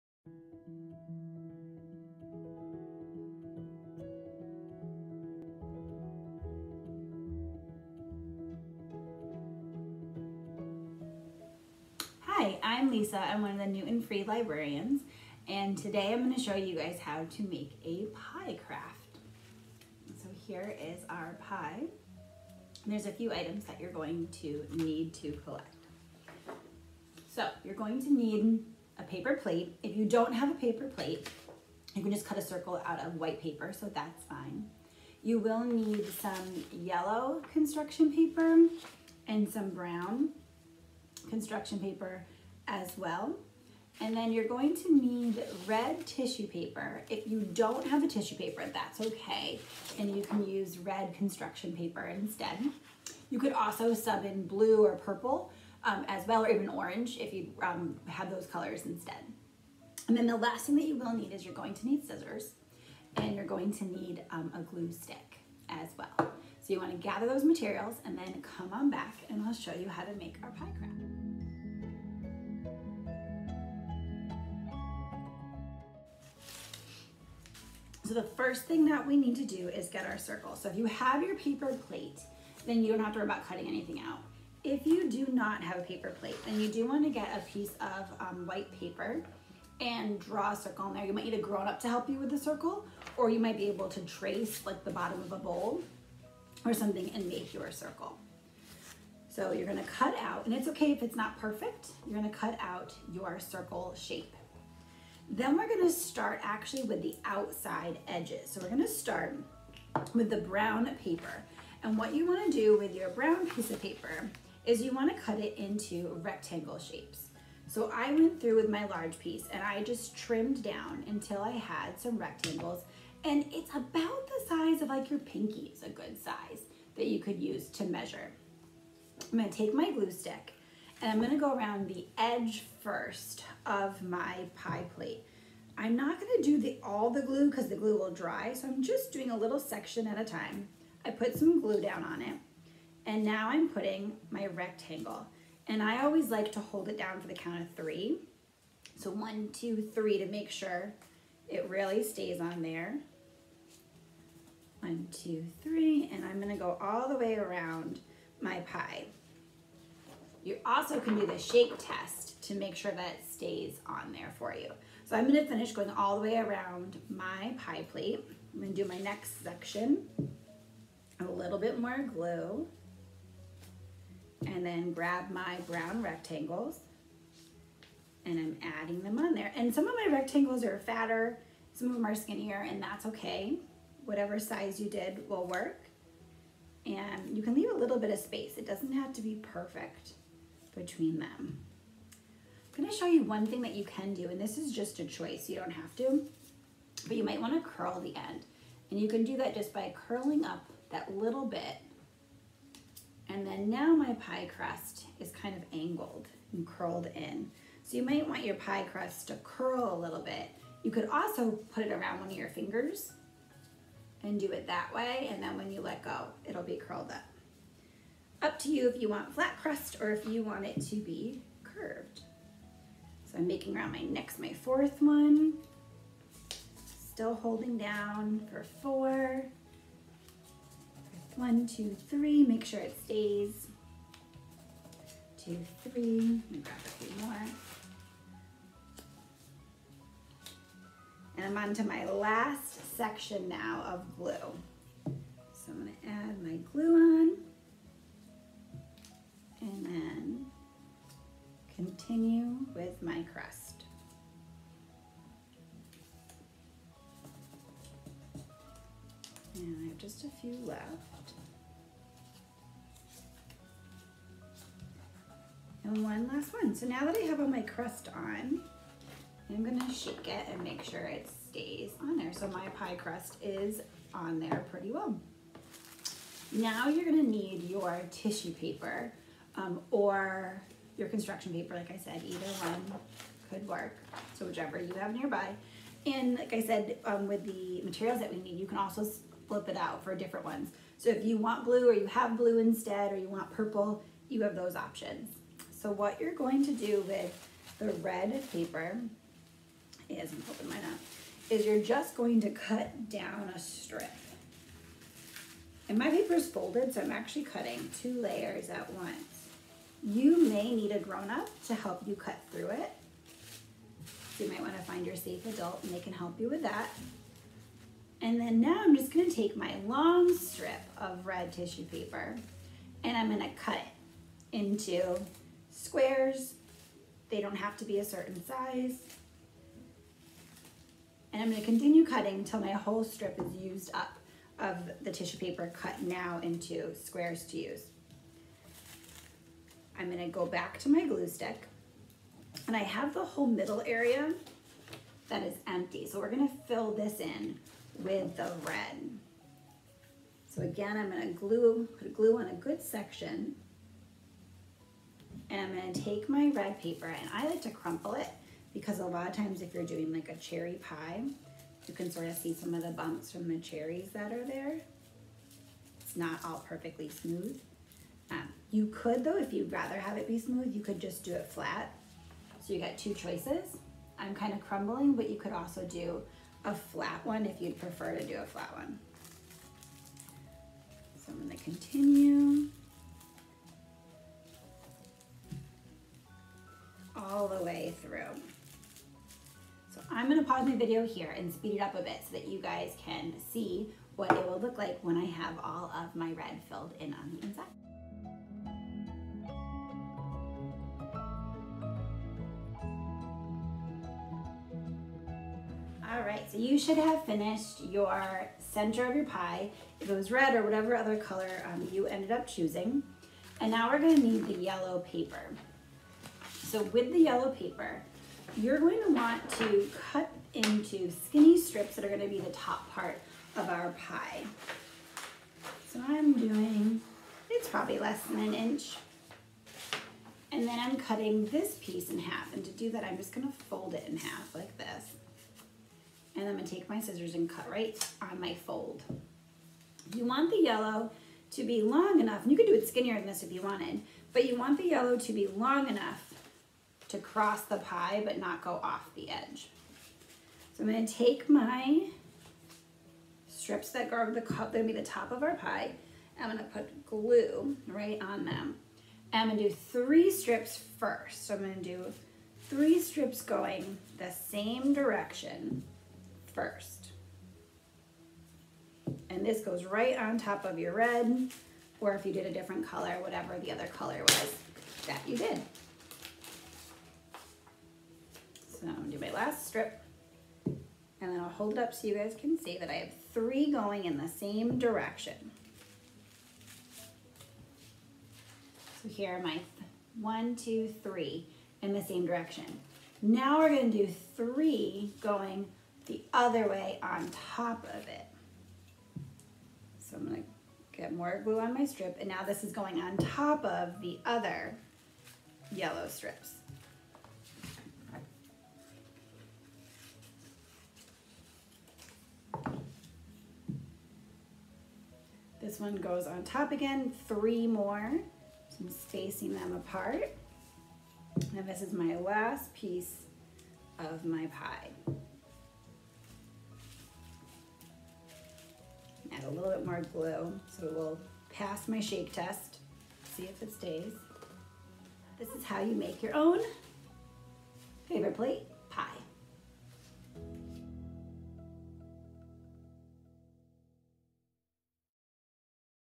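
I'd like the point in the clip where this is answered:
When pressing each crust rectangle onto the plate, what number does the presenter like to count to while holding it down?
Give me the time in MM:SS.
02:27.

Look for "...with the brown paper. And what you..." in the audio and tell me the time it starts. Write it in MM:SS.
01:50.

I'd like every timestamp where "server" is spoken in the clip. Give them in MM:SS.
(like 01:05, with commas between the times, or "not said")
not said.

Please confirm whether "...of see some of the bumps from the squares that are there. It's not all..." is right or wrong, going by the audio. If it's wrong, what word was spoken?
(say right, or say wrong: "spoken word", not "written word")
wrong: "cherries", not "squares".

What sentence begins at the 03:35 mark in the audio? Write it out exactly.
And then when you let go, it'll be curled up.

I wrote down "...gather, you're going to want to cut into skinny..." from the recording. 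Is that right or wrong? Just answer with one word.
wrong.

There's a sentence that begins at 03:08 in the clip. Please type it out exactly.
It doesn't have to be perfect between them.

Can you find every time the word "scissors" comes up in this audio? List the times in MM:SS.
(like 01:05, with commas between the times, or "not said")
01:02, 07:16.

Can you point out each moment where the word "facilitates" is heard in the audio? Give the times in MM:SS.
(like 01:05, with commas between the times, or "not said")
not said.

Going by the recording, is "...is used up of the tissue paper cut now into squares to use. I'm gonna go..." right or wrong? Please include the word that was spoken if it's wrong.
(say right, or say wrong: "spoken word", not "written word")
right.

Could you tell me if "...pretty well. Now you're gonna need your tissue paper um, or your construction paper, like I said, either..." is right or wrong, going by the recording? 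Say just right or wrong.
right.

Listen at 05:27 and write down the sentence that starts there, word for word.
They don't have to be a certain size.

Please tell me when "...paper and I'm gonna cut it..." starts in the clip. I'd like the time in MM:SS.
05:21.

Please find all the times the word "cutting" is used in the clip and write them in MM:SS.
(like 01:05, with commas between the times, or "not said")
01:23, 05:07, 05:32, 07:10.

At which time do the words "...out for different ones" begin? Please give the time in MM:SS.
04:49.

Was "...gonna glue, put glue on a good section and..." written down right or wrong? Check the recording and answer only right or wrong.
right.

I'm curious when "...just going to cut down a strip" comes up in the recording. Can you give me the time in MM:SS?
05:01.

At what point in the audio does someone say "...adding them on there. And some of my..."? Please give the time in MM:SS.
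02:58.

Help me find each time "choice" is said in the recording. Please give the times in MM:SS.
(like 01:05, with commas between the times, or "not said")
03:15, 06:13.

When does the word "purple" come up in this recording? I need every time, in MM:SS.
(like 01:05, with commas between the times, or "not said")
00:54, 04:53.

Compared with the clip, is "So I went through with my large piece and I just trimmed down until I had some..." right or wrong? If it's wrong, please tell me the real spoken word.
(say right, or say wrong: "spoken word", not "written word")
right.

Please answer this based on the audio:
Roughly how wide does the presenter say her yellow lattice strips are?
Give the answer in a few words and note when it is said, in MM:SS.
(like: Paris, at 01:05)
Less than an inch, at 07:07.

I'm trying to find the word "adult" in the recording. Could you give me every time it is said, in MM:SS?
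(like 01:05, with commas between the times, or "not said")
05:15.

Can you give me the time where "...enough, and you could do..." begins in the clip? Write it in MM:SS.
07:22.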